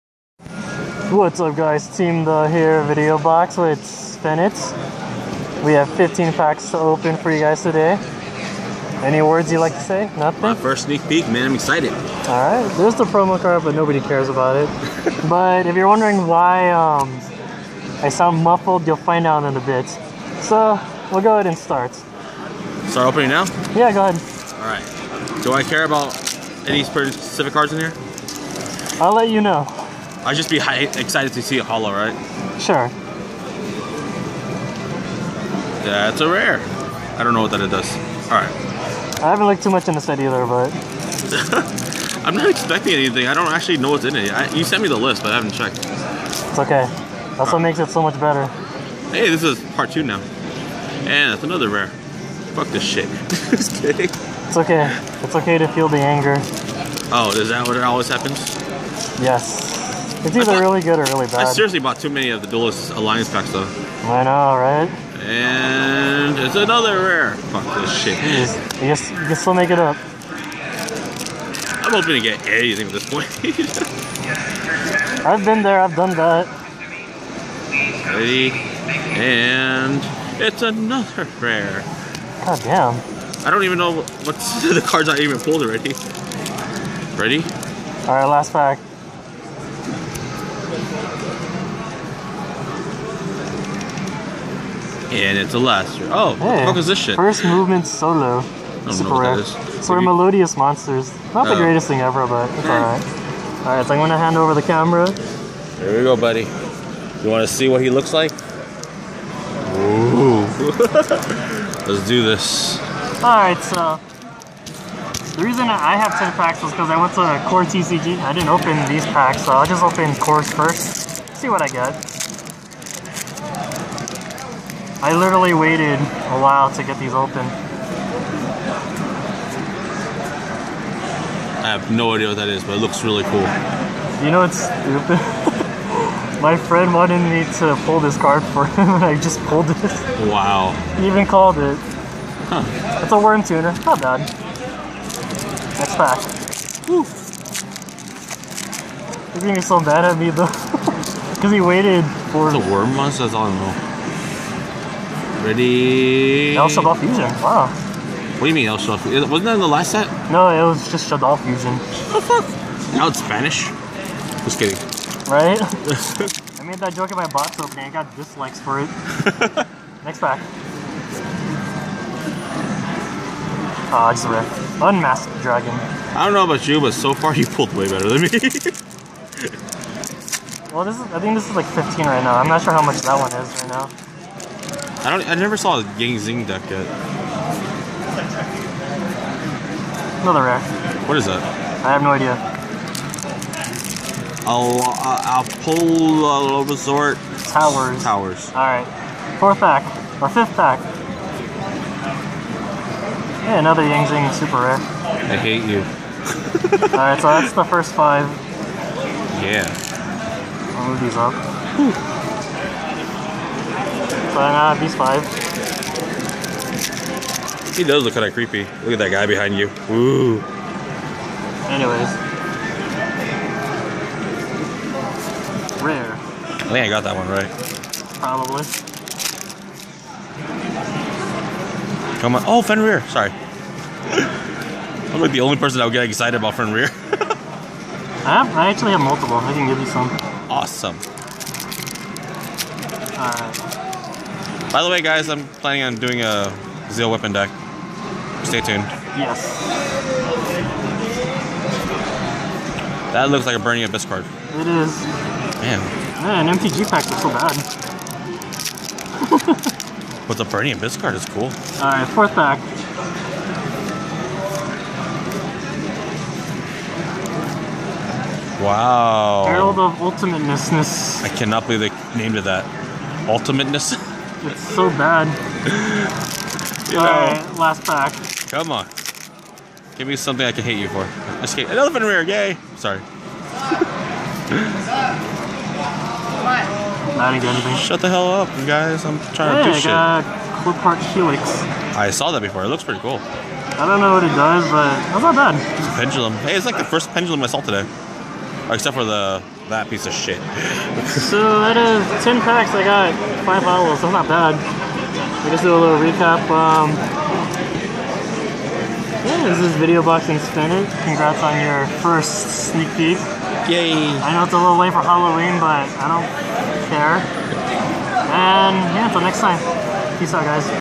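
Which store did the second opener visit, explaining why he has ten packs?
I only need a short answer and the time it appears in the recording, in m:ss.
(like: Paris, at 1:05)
Core TCG, at 1:57.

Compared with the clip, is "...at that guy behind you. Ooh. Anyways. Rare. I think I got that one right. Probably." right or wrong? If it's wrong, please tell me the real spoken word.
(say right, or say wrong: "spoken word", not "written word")
right.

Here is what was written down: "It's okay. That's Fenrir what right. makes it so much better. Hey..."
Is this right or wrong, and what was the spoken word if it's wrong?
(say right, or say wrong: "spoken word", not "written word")
wrong: "All", not "Fenrir".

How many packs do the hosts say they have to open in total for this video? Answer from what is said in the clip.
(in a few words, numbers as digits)
15.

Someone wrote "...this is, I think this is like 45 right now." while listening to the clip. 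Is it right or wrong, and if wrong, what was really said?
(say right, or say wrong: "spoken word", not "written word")
wrong: "15", not "45".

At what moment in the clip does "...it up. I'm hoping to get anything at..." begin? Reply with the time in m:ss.
1:09.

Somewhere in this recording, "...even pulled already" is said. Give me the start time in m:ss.
1:25.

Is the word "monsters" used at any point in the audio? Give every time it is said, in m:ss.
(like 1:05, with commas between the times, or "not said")
1:40, 2:32.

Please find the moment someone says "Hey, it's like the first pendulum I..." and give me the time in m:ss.
4:56.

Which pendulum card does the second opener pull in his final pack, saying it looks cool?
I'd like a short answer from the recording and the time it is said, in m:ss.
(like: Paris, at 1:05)
Qliphort Helix, at 4:50.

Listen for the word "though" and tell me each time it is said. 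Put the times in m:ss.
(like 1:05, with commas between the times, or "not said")
1:03, 2:30.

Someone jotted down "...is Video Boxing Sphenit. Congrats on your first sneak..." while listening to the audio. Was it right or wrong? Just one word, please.
right.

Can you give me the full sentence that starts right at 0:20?
So, we'll go ahead and start.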